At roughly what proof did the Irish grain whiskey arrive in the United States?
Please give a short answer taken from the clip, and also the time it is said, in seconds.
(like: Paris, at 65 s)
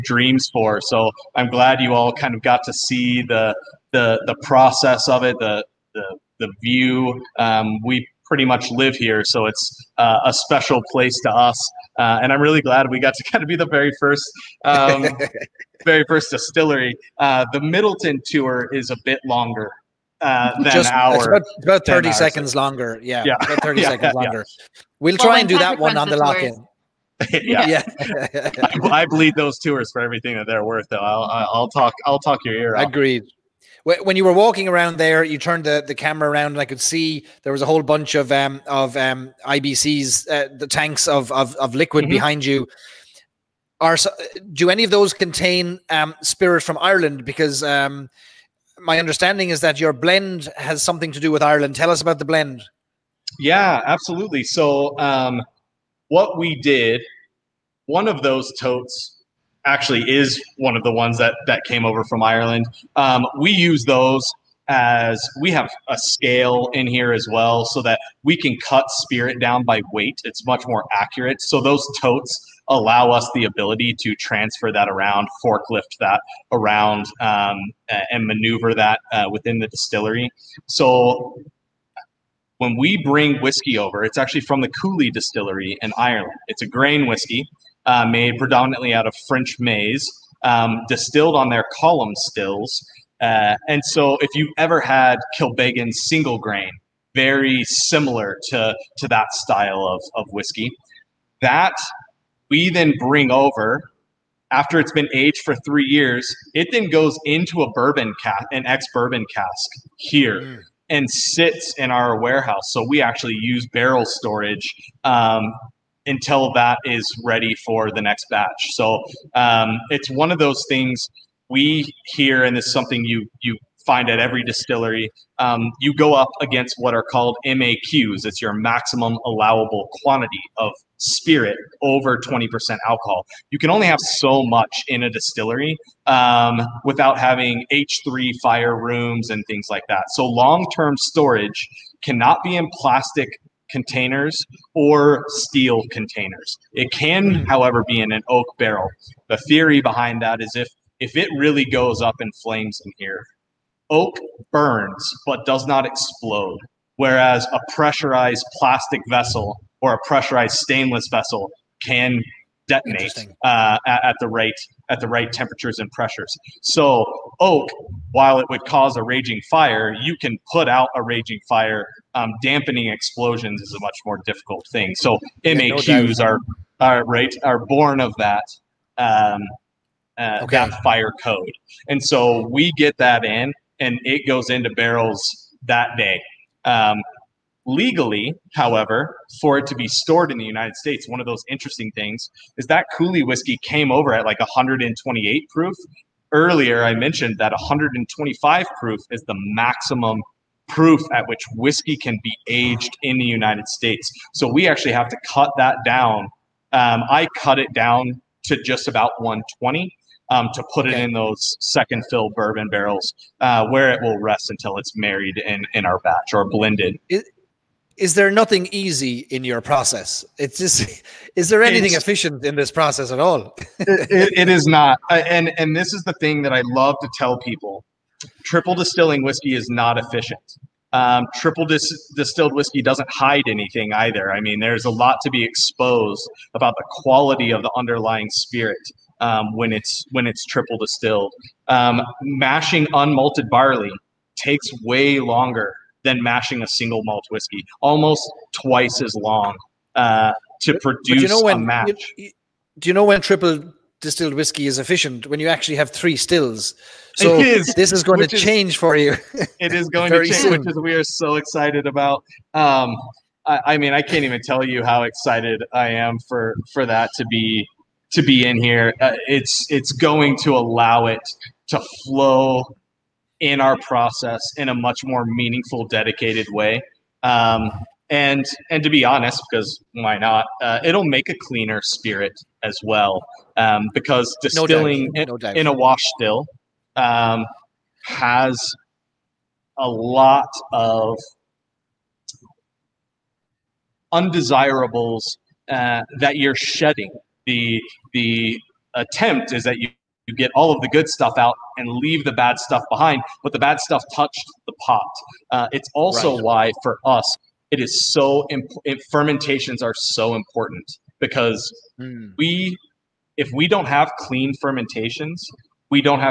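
128 proof, at 194 s.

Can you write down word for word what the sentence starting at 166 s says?
So oak, while it would cause a raging fire, you can put out a raging fire.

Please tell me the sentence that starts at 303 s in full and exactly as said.
But the bad stuff touched the pot.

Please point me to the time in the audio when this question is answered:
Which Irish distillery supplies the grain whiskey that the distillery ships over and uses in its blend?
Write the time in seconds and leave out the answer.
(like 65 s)
84 s.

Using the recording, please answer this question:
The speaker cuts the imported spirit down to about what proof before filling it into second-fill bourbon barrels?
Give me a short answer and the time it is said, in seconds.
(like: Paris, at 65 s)
120, at 209 s.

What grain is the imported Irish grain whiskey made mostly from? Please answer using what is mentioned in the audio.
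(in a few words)
French maize.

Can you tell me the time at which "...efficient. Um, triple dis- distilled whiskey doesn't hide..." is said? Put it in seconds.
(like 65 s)
229 s.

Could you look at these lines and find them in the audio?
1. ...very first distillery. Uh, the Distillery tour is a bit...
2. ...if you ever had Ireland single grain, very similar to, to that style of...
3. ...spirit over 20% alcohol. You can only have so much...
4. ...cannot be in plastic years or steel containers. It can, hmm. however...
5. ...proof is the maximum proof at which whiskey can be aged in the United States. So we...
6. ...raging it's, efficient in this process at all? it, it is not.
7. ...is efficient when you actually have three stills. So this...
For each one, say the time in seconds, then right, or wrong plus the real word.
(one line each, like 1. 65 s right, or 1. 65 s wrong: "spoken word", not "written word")
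1. 15 s wrong: "Midleton", not "Distillery"
2. 94 s wrong: "Kilbeggan", not "Ireland"
3. 130 s right
4. 142 s wrong: "containers", not "years"
5. 198 s right
6. 221 s wrong: "anything", not "raging"
7. 254 s right.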